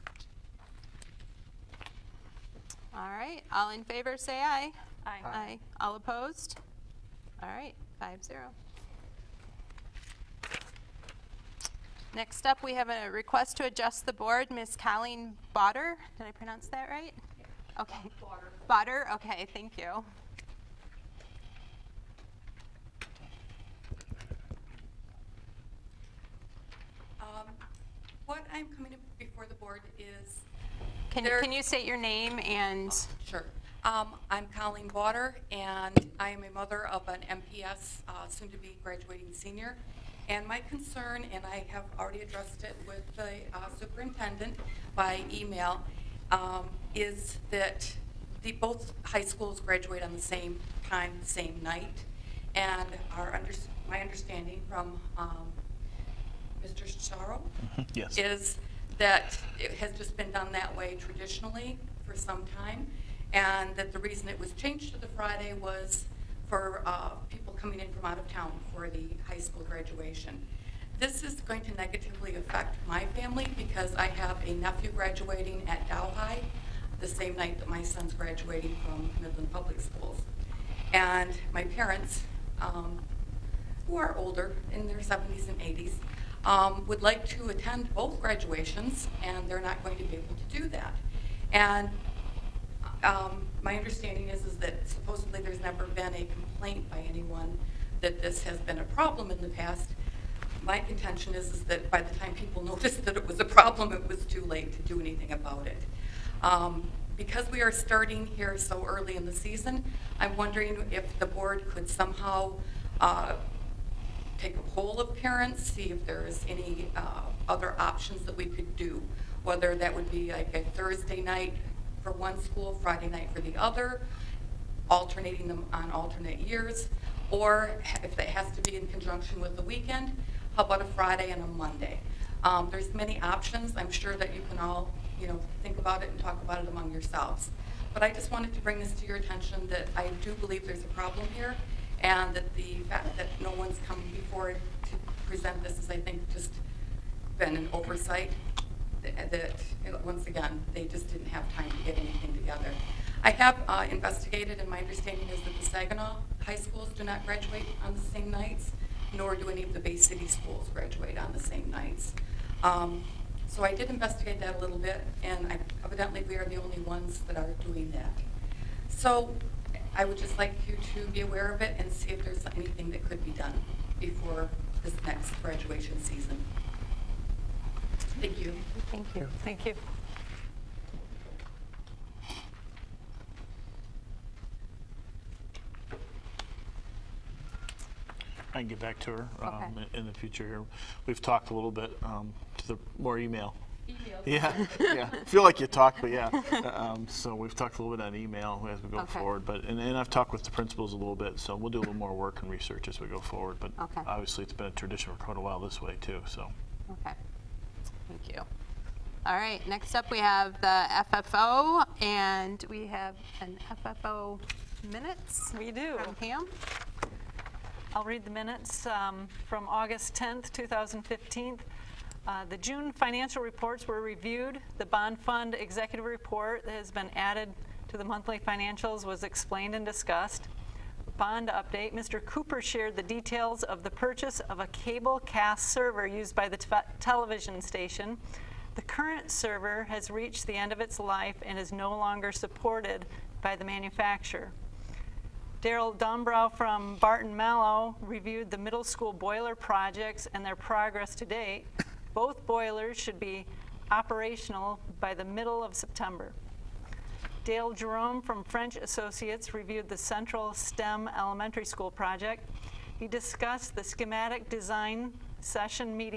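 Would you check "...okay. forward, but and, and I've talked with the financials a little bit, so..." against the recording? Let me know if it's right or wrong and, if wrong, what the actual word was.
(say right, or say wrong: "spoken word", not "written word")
wrong: "principals", not "financials".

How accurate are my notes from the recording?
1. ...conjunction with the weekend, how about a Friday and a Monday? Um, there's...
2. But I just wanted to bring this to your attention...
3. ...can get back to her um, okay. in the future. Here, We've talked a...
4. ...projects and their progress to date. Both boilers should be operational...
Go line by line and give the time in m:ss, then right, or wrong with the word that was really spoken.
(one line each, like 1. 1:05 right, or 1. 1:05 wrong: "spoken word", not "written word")
1. 2:08 right
2. 2:17 right
3. 3:08 right
4. 4:09 right.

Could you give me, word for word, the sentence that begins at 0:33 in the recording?
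Um, I'm Colleen Water, and I am a mother of an MPS, uh, soon-to-be graduating senior.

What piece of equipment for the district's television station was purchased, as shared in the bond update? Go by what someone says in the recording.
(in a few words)
cable cast server.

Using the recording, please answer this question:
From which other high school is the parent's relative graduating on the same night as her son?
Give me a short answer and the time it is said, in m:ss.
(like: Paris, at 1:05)
Dow High, at 1:15.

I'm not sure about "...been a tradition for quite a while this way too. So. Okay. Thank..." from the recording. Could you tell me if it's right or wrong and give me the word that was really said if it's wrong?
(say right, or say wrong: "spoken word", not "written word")
right.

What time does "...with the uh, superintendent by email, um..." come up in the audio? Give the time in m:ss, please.
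0:42.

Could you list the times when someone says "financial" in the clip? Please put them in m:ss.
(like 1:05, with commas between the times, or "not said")
3:42, 3:48.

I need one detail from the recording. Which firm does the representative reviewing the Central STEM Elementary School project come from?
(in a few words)
French Associates.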